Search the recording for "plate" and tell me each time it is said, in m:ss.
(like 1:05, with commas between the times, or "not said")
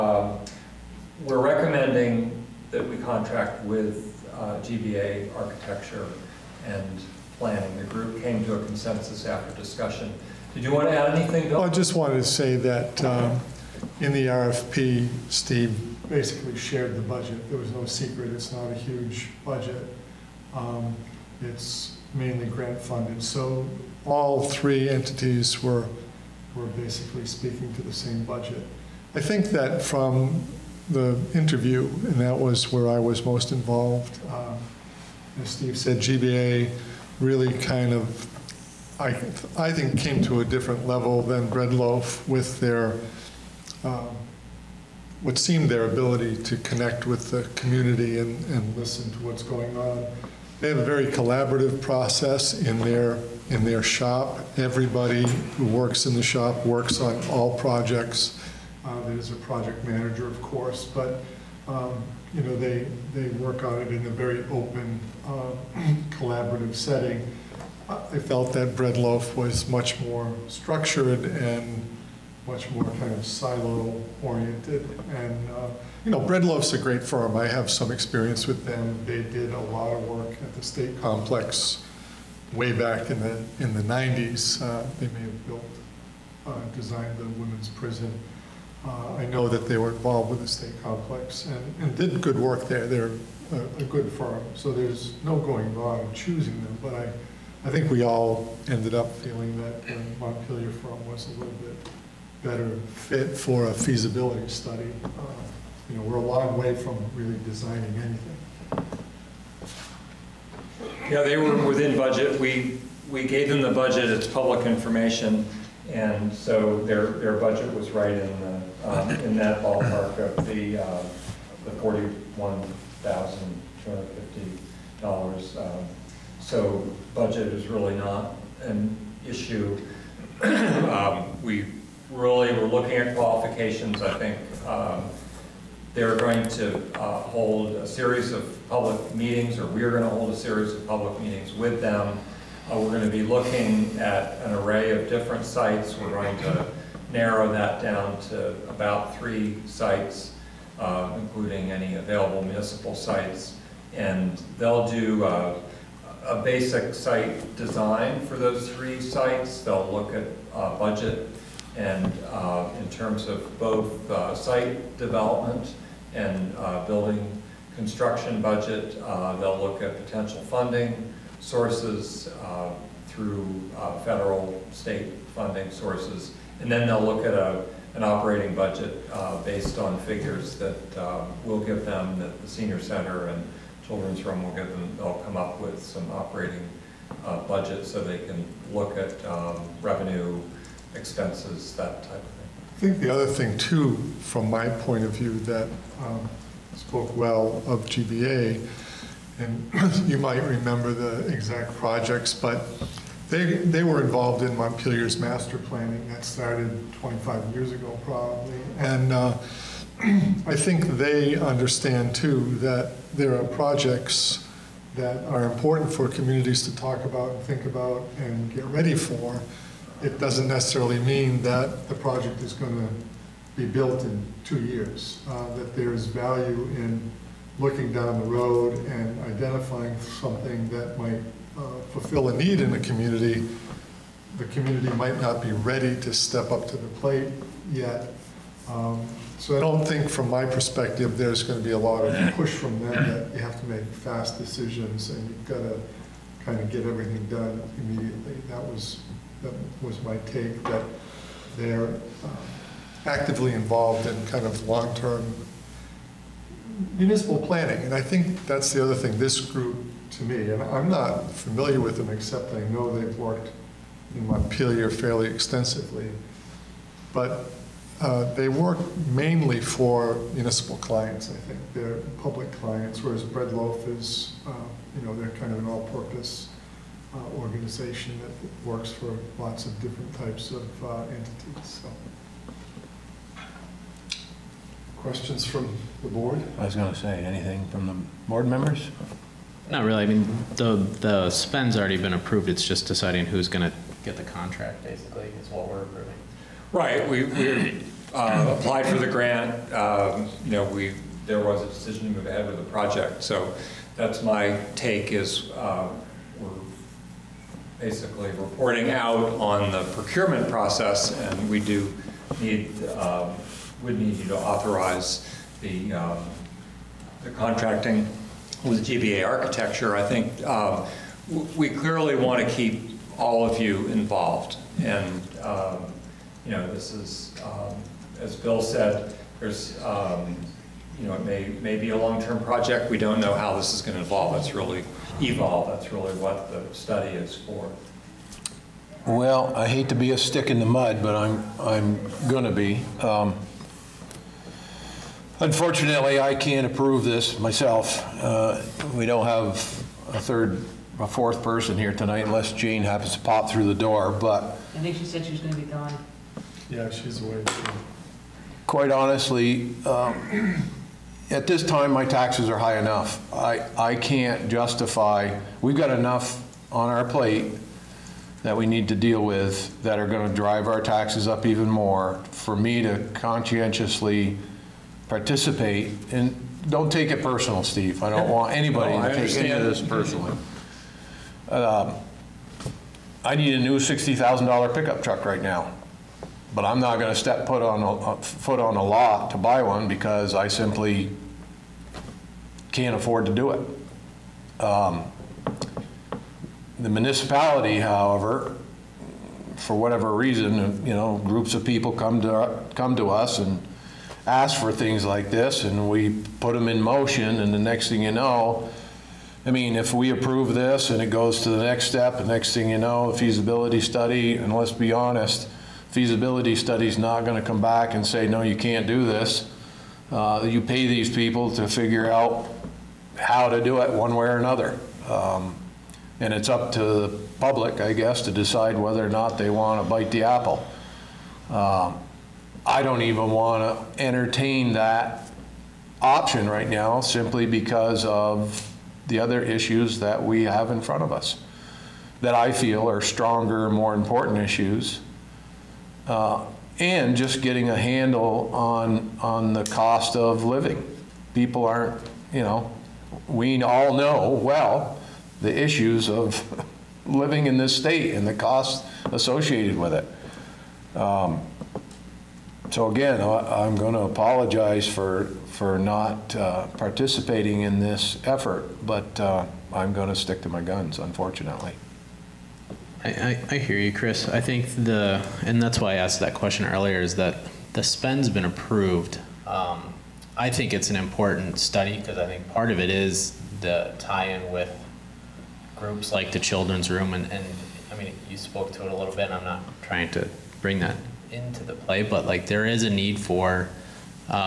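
3:56, 6:07.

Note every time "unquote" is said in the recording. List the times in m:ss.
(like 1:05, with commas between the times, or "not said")
not said.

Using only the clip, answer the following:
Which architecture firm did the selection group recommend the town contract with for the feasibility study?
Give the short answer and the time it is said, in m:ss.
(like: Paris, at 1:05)
GBA architecture and planning, at 0:04.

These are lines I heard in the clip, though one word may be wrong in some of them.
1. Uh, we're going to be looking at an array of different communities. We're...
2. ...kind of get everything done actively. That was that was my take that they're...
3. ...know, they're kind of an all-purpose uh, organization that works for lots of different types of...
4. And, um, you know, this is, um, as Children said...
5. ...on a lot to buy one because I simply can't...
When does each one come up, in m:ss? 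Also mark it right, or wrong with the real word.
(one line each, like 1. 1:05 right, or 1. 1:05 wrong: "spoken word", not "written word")
1. 2:22 wrong: "sites", not "communities"
2. 4:06 wrong: "immediately", not "actively"
3. 4:35 right
4. 5:24 wrong: "Bill", not "Children"
5. 6:28 right.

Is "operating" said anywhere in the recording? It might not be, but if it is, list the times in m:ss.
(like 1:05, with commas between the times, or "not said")
2:58, 3:06.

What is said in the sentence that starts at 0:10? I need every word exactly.
Did you want to add anything, Bill?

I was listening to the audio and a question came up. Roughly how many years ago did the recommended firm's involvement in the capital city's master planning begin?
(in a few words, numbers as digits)
25.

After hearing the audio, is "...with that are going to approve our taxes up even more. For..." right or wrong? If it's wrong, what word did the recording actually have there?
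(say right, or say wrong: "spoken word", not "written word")
wrong: "drive", not "approve".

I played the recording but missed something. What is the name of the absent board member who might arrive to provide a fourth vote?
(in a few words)
Jane.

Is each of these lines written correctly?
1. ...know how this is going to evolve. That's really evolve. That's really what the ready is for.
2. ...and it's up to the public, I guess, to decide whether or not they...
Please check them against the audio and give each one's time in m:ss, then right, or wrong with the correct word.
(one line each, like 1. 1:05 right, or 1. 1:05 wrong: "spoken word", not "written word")
1. 5:33 wrong: "study", not "ready"
2. 7:06 right.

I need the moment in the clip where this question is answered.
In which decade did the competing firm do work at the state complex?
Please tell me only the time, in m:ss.
1:23.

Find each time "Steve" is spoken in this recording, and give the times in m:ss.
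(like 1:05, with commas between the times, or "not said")
0:15, 0:35, 6:17.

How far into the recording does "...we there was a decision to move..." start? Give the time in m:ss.
5:00.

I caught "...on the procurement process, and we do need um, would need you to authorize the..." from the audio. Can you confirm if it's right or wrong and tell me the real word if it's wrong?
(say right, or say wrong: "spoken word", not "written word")
right.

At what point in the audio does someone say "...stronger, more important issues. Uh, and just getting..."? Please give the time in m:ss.
7:23.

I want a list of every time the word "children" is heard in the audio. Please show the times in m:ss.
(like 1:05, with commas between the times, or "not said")
3:03, 8:06.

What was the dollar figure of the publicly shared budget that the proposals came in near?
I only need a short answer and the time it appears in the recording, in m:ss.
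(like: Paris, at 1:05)
$41,250, at 2:01.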